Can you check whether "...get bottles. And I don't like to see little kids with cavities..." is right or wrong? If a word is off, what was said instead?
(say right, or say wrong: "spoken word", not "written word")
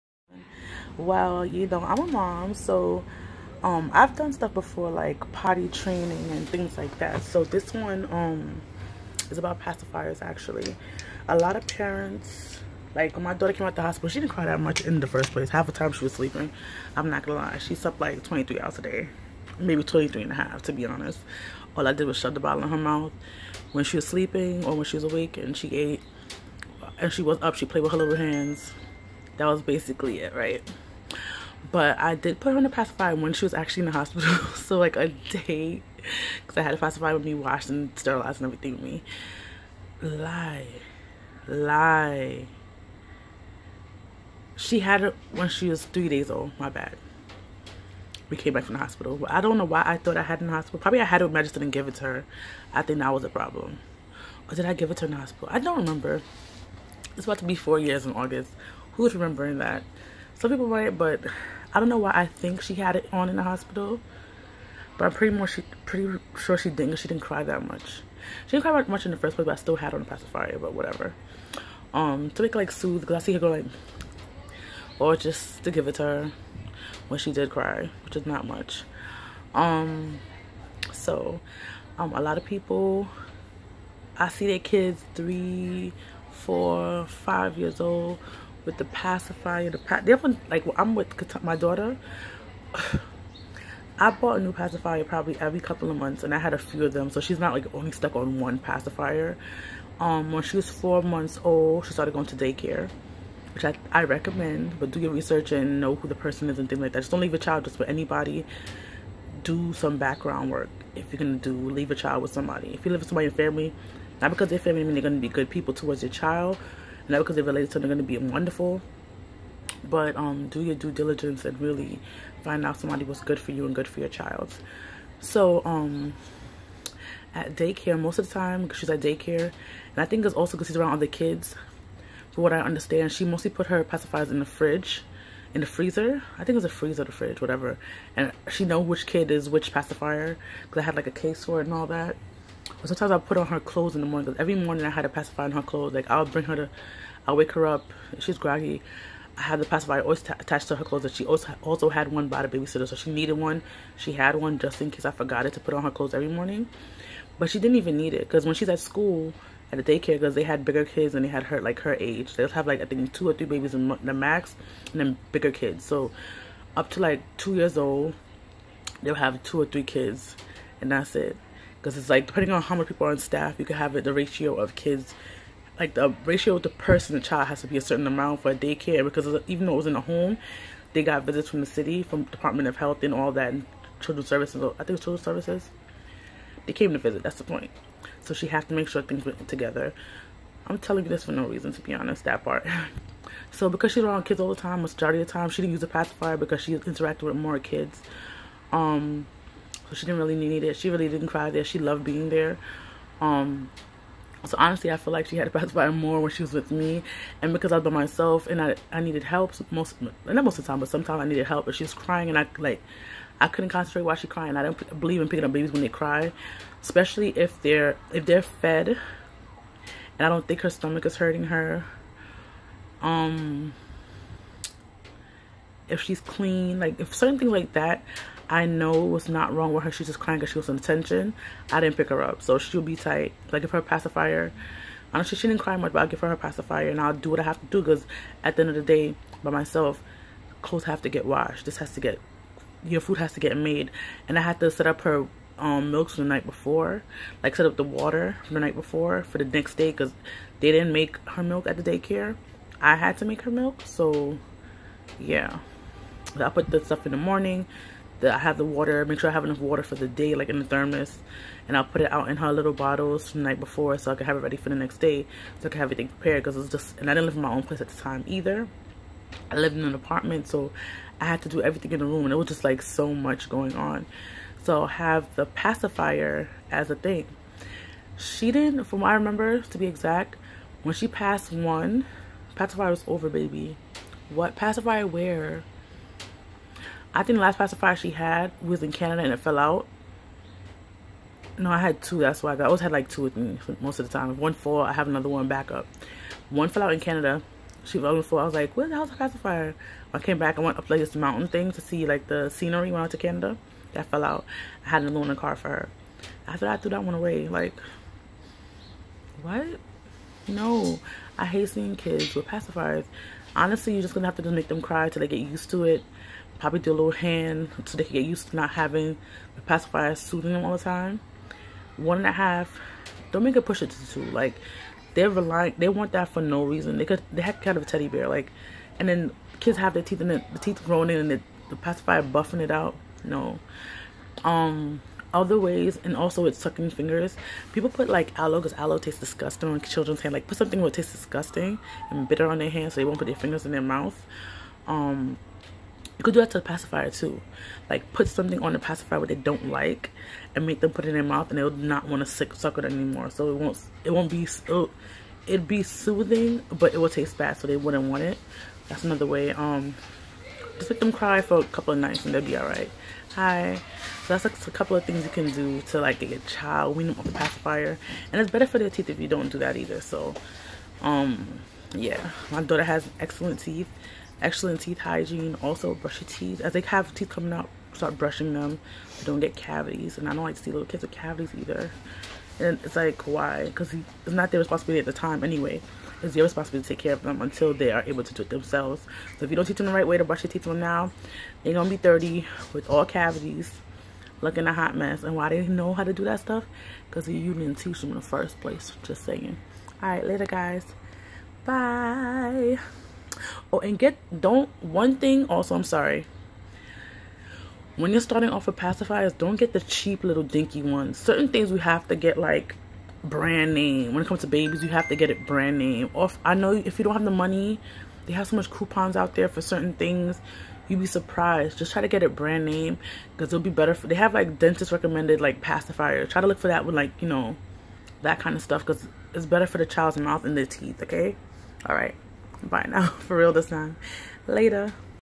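wrong: "cavities", not "bottles".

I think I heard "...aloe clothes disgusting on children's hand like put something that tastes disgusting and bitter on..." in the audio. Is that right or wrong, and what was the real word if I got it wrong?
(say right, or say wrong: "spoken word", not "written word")
wrong: "tastes", not "clothes".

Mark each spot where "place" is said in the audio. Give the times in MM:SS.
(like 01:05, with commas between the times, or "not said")
00:15, 01:09, 04:27, 06:38.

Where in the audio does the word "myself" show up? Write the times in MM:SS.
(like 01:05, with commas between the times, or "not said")
03:27, 03:59.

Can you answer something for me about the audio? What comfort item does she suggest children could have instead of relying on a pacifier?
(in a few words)
teddy bear.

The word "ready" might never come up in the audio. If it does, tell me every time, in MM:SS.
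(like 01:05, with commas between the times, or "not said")
04:24.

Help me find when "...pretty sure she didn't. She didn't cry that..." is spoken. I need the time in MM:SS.
01:05.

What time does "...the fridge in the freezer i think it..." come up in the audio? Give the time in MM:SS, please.
02:14.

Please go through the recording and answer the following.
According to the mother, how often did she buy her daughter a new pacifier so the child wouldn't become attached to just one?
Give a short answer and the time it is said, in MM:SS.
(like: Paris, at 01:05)
every couple of months, at 01:35.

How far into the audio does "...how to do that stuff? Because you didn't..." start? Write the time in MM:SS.
06:35.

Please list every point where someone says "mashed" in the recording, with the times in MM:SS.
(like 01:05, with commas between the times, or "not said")
not said.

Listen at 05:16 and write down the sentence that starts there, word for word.
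Probably do a little hand so they can get used to not having the pacifier soothing them all the time.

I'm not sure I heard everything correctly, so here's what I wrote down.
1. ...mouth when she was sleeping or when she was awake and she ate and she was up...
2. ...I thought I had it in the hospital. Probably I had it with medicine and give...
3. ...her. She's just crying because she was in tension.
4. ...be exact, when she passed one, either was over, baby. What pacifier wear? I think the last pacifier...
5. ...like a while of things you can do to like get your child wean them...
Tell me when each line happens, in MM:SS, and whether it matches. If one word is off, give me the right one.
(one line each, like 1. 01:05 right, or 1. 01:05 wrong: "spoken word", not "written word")
1. 00:22 right
2. 00:49 right
3. 03:49 right
4. 04:39 wrong: "pacifier", not "either"
5. 06:04 wrong: "couple", not "while".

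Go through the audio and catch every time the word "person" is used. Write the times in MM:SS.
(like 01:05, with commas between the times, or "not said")
01:46, 02:56.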